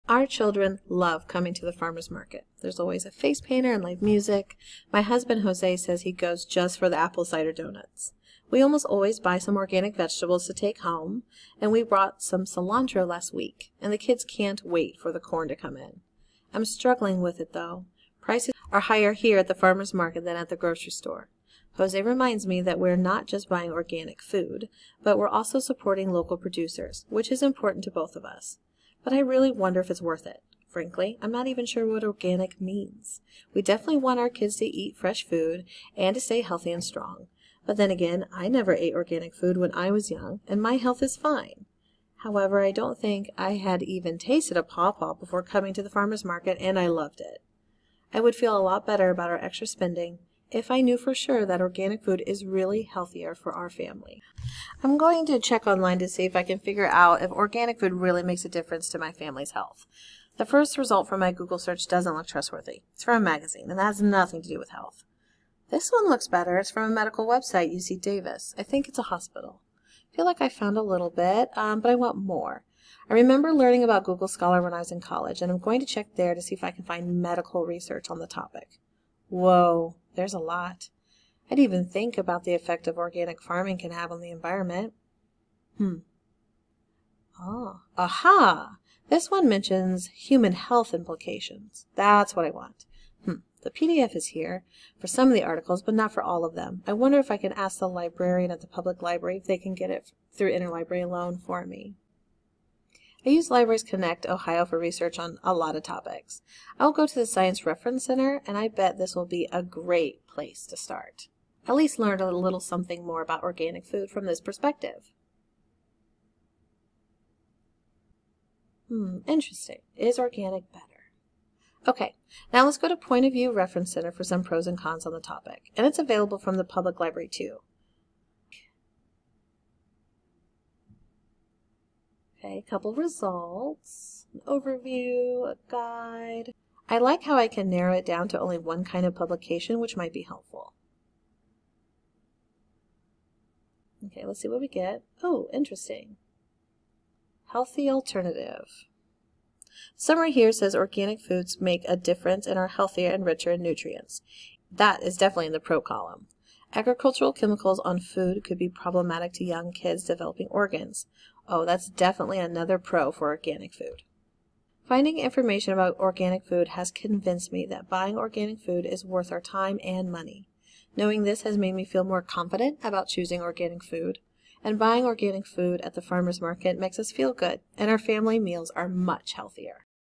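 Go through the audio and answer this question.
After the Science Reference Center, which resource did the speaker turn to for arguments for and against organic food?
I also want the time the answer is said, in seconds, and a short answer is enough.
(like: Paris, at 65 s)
Point of View Reference Center, at 122 s.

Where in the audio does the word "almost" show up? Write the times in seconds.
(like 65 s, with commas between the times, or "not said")
8 s.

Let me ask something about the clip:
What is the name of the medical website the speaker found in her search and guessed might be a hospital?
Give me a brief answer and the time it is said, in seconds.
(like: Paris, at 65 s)
UC Davis, at 67 s.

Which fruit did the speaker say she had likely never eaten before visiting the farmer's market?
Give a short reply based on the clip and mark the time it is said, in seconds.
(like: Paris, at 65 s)
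pawpaw, at 44 s.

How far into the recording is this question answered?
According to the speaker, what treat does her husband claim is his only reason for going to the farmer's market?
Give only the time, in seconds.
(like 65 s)
6 s.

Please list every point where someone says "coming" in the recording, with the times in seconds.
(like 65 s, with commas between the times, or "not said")
1 s, 45 s.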